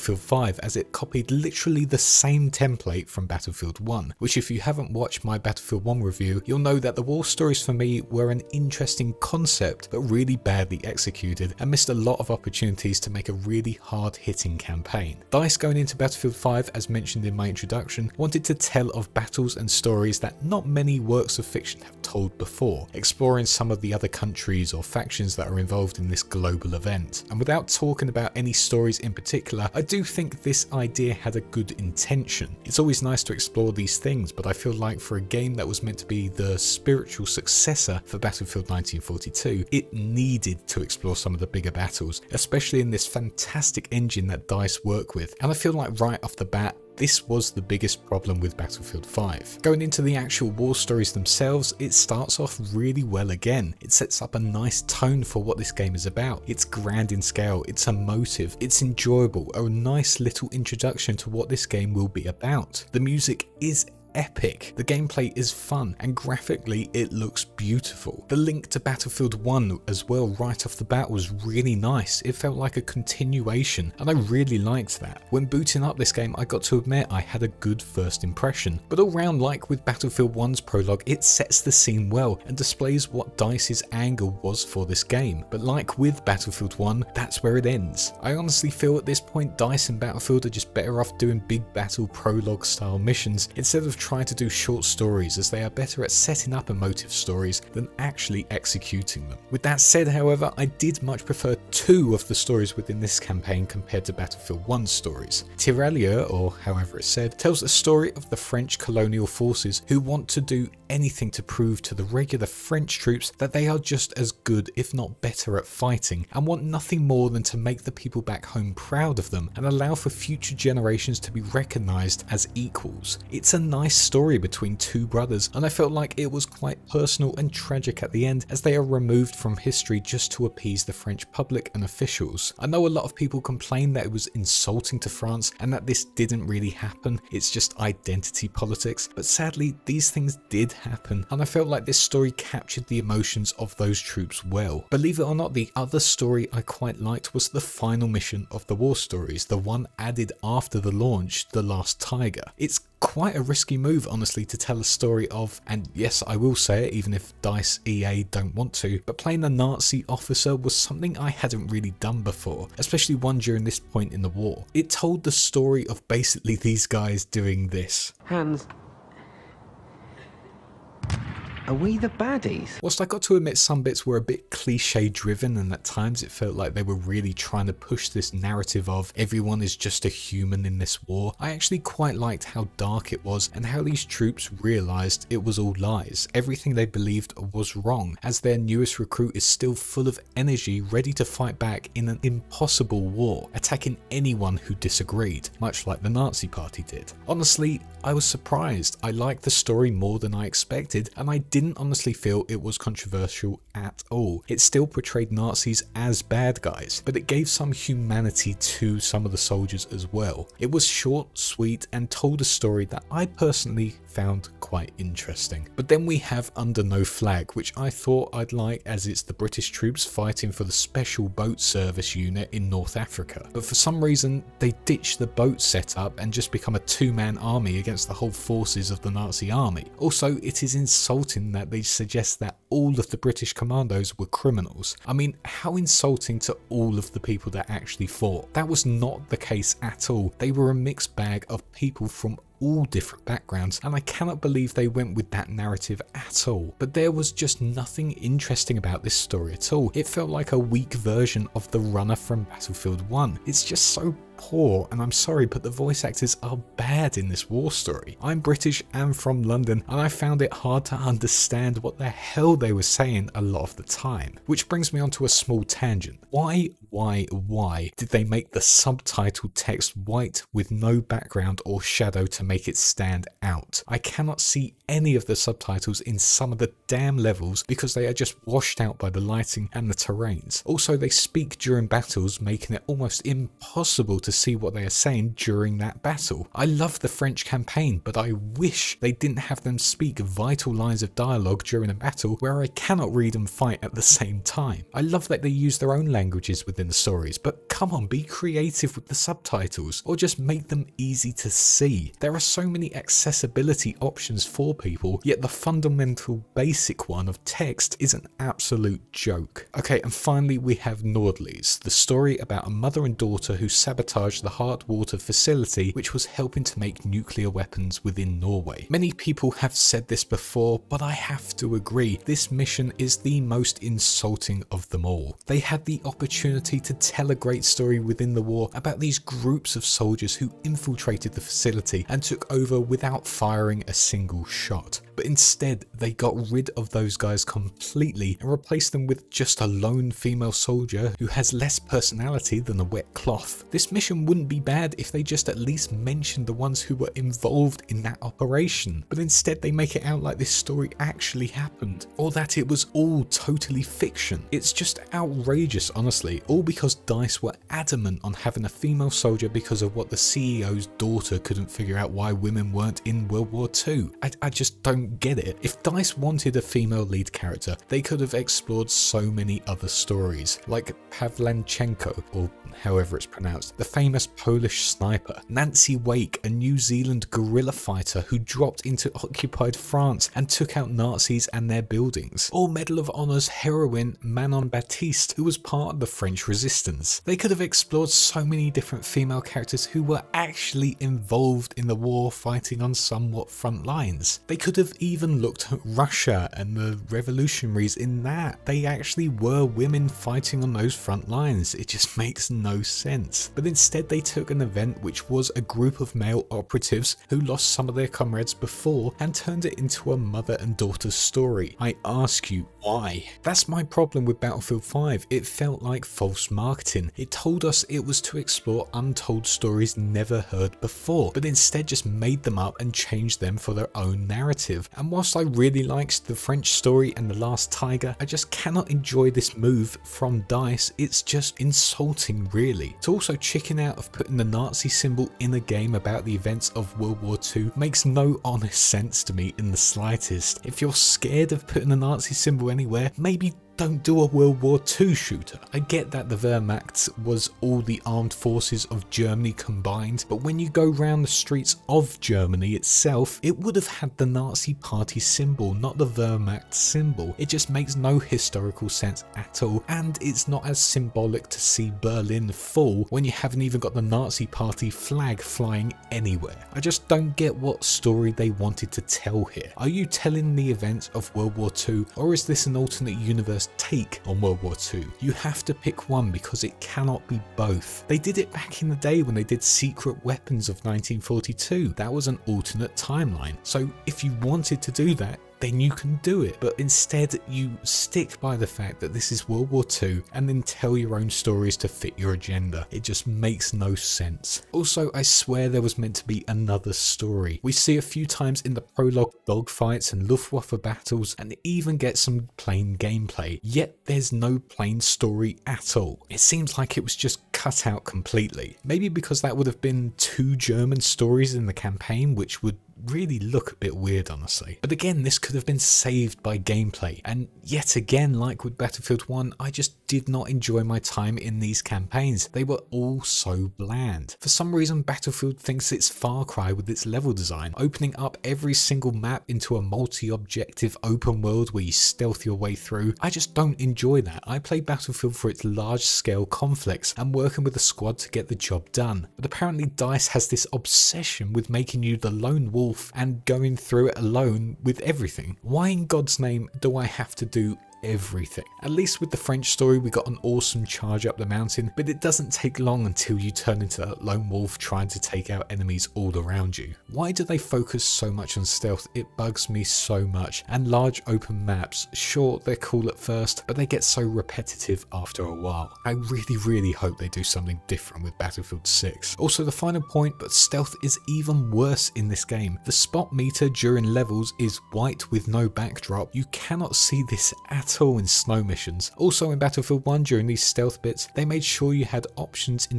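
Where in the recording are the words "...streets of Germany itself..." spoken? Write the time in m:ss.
7:31.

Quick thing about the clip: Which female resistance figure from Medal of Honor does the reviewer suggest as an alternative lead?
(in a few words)
Manon Baptiste.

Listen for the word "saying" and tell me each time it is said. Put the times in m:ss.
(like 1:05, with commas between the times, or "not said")
4:22, 4:44.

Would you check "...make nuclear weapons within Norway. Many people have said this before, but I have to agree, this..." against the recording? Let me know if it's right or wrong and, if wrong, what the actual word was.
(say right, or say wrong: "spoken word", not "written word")
right.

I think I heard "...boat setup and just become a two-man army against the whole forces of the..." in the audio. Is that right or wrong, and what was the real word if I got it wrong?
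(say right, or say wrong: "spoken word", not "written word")
right.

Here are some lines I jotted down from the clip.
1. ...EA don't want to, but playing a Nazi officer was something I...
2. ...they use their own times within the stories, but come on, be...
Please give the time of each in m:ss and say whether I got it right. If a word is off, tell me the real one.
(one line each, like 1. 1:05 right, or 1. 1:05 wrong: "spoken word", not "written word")
1. 2:37 right
2. 4:55 wrong: "languages", not "times".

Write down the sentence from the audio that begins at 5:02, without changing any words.
There are so many accessibility options for people, yet the fundamental basic one of text is an absolute joke.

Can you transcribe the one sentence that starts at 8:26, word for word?
It seems like it was just cut out completely.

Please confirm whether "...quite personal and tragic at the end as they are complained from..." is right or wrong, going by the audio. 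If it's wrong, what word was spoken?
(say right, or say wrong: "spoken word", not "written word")
wrong: "removed", not "complained".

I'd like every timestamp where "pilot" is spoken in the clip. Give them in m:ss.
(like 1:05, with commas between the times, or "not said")
not said.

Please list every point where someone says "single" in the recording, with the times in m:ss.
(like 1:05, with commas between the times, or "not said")
5:33, 8:48.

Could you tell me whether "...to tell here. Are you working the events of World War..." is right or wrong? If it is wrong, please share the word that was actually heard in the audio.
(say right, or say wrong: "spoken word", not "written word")
wrong: "telling", not "working".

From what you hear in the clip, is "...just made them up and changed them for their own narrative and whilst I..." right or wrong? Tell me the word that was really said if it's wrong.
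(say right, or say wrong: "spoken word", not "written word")
right.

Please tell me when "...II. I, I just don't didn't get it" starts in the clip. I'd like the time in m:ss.
6:03.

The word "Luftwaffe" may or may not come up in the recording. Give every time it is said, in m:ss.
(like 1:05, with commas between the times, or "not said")
8:20.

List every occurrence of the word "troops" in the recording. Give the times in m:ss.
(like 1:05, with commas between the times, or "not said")
1:52, 2:24, 3:04, 3:39.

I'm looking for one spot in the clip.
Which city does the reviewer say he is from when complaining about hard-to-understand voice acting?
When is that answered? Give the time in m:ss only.
4:19.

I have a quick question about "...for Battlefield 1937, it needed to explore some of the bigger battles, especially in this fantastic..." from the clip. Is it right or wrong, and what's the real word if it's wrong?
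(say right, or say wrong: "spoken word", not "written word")
wrong: "1942", not "1937".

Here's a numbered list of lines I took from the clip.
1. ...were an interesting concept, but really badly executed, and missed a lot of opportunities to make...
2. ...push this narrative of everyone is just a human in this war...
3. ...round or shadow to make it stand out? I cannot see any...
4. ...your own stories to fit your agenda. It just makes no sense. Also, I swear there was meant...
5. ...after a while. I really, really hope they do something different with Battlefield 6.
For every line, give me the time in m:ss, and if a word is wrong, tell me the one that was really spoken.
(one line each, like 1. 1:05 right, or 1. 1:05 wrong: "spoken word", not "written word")
1. 0:08 right
2. 2:57 right
3. 4:31 wrong: "background", not "round"
4. 8:10 right
5. 9:25 right.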